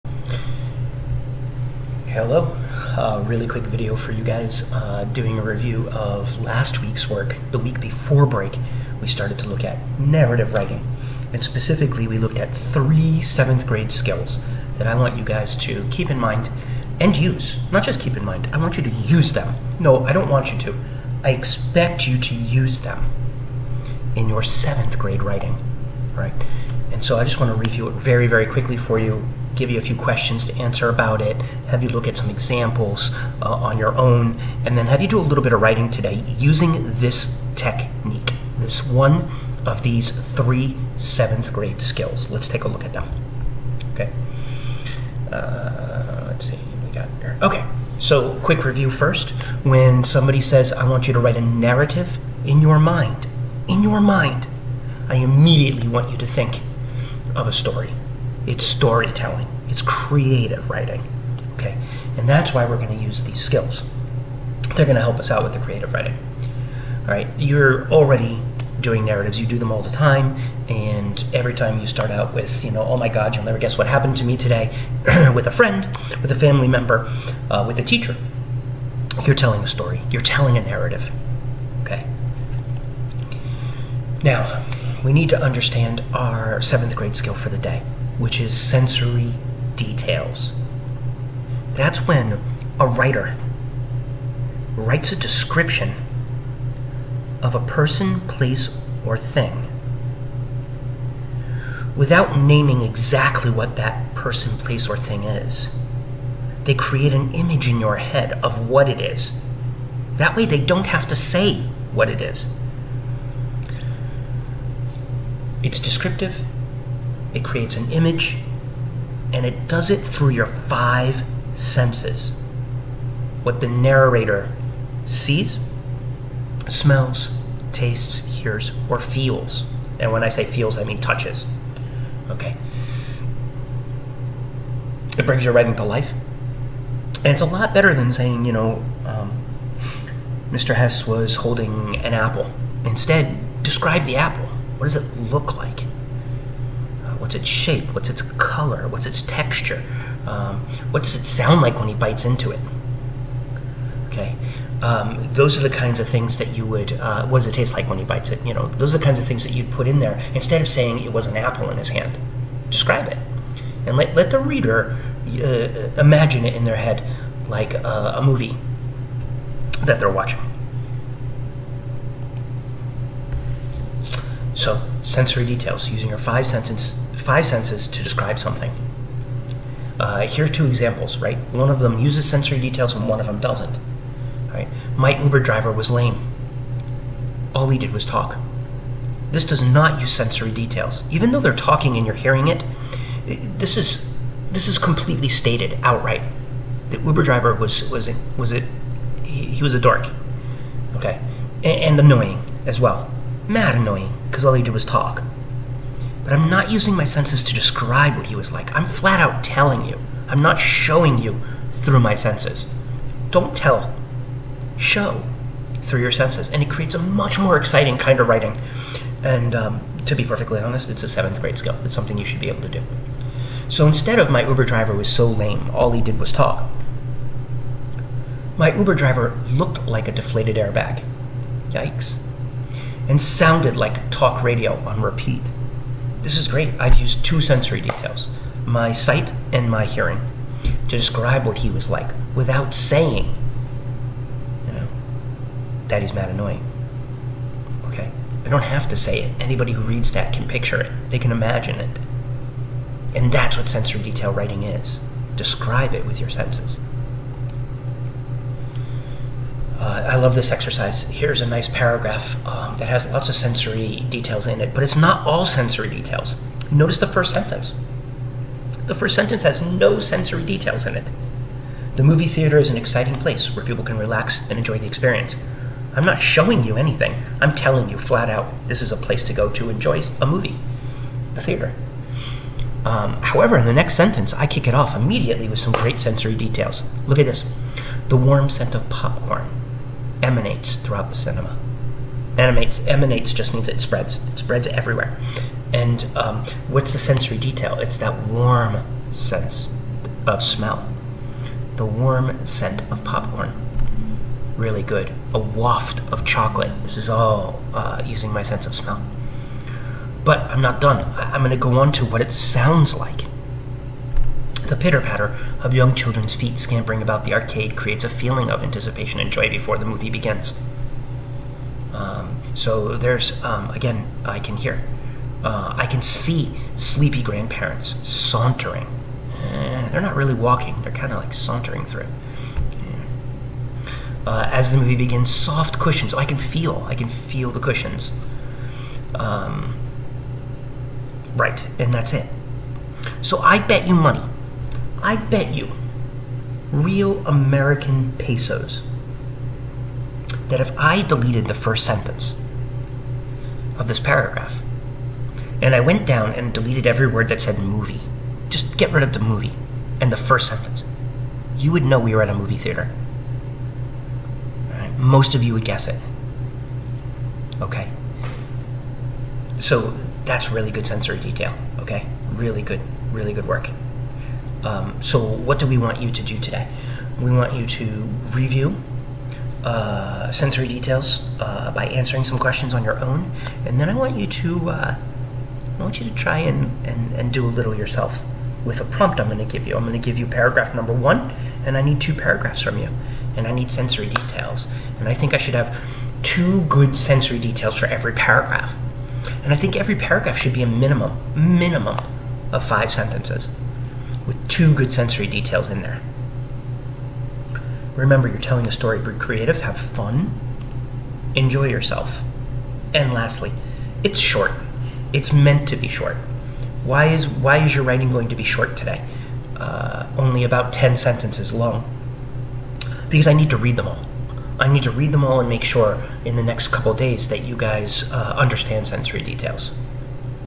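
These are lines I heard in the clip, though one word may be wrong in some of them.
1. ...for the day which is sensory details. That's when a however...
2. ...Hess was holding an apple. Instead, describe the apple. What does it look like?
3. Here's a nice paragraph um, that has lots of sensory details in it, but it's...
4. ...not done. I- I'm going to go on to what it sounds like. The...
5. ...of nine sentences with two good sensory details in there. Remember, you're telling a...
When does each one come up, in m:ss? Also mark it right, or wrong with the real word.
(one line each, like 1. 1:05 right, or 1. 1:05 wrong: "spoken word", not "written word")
1. 1:27 wrong: "writer", not "however"
2. 2:20 right
3. 4:21 right
4. 5:10 right
5. 6:42 wrong: "five", not "nine".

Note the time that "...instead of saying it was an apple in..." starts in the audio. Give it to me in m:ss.
2:40.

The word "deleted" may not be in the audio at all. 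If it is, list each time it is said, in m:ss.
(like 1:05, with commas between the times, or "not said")
5:51, 5:56.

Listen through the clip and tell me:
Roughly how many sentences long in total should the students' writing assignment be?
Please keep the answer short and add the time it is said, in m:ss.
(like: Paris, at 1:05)
10, at 7:00.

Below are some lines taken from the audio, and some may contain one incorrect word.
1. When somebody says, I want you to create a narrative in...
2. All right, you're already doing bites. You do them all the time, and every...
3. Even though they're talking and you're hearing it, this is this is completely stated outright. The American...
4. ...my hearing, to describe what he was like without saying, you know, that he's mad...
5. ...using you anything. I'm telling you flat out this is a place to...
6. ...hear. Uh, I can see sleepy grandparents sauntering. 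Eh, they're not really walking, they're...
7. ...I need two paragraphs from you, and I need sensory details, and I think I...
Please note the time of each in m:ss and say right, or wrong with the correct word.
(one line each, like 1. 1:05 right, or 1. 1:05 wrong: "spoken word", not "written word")
1. 0:49 wrong: "write", not "create"
2. 1:07 wrong: "narratives", not "bites"
3. 3:11 wrong: "Uber", not "American"
4. 3:59 right
5. 4:36 wrong: "showing", not "using"
6. 5:24 right
7. 6:31 right.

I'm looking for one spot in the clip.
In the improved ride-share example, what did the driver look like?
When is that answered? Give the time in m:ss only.
3:50.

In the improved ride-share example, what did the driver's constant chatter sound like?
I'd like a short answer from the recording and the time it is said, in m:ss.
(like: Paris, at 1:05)
talk radio on repeat, at 3:54.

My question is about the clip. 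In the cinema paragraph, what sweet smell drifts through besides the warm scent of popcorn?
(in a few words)
chocolate.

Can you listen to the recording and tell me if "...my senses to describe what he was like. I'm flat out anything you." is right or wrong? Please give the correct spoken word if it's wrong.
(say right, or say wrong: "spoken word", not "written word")
wrong: "telling", not "anything".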